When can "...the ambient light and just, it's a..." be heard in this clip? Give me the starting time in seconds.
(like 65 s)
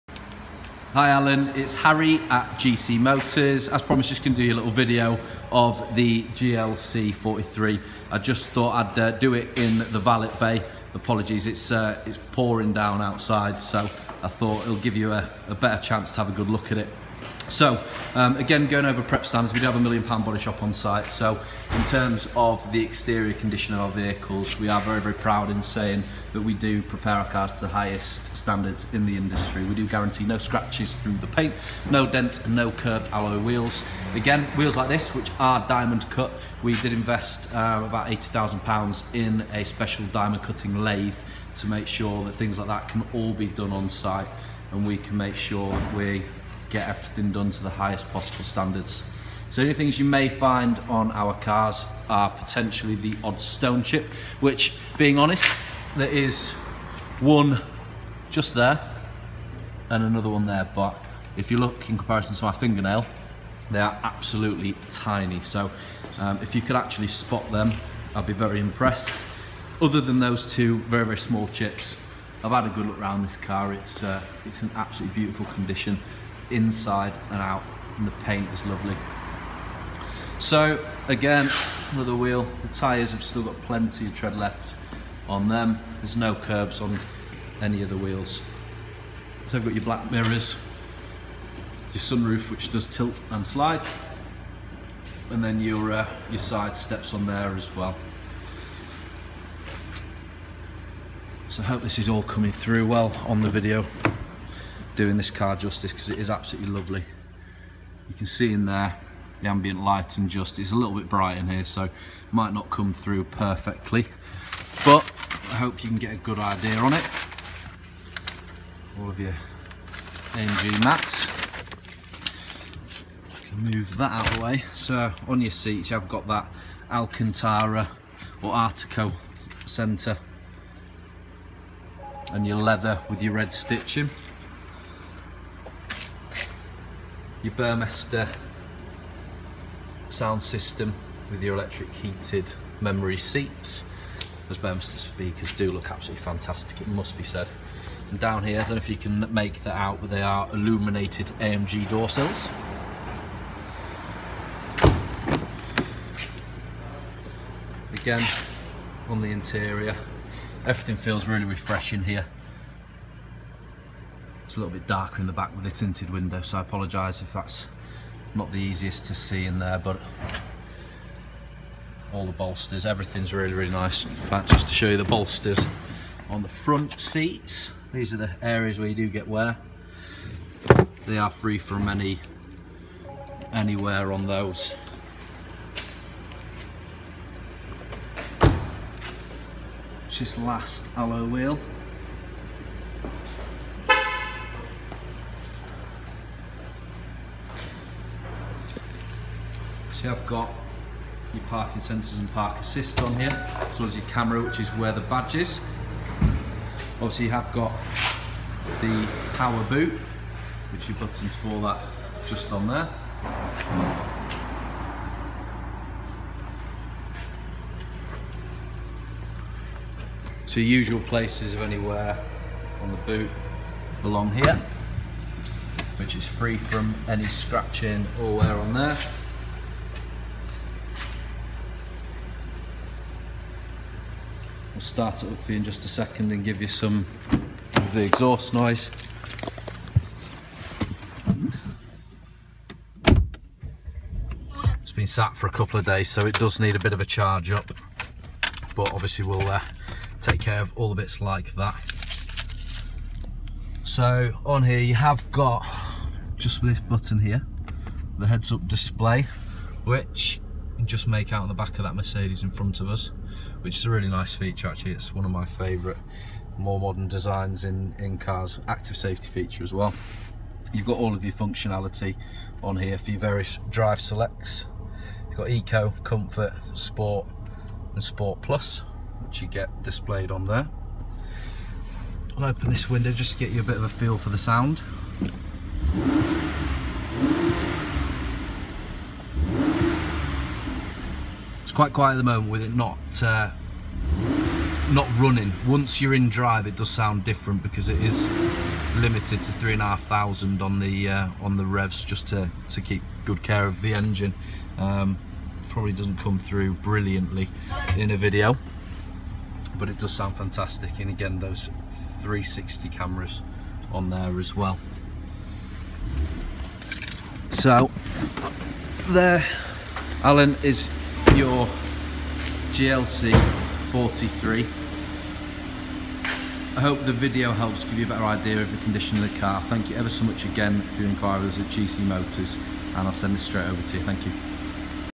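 109 s.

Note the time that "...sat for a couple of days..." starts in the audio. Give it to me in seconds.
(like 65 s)
245 s.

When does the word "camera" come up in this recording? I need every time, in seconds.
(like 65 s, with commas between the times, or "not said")
204 s, 312 s.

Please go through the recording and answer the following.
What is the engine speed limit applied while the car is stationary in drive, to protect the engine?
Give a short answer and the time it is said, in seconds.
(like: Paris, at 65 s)
3,500 revs, at 299 s.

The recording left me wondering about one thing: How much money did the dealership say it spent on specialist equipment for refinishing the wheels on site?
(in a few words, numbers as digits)
£80,000.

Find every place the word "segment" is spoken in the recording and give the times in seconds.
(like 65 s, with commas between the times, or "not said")
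not said.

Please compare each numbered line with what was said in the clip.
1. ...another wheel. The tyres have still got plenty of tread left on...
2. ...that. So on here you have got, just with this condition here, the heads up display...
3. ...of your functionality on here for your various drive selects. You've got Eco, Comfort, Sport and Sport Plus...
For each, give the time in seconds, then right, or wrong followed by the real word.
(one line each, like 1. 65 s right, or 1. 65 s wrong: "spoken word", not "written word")
1. 81 s right
2. 251 s wrong: "button", not "condition"
3. 271 s right.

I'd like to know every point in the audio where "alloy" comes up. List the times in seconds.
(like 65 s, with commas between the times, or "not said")
33 s, 190 s.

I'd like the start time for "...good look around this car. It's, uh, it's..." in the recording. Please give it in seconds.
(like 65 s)
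72 s.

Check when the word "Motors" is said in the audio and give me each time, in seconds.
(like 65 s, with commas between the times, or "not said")
2 s, 332 s.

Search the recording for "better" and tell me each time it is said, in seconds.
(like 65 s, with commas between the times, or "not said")
15 s, 328 s.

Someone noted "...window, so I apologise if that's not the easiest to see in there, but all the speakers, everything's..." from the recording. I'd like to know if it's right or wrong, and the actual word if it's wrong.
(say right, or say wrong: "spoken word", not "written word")
wrong: "bolsters", not "speakers".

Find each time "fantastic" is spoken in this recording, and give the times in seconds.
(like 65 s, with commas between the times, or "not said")
146 s, 310 s.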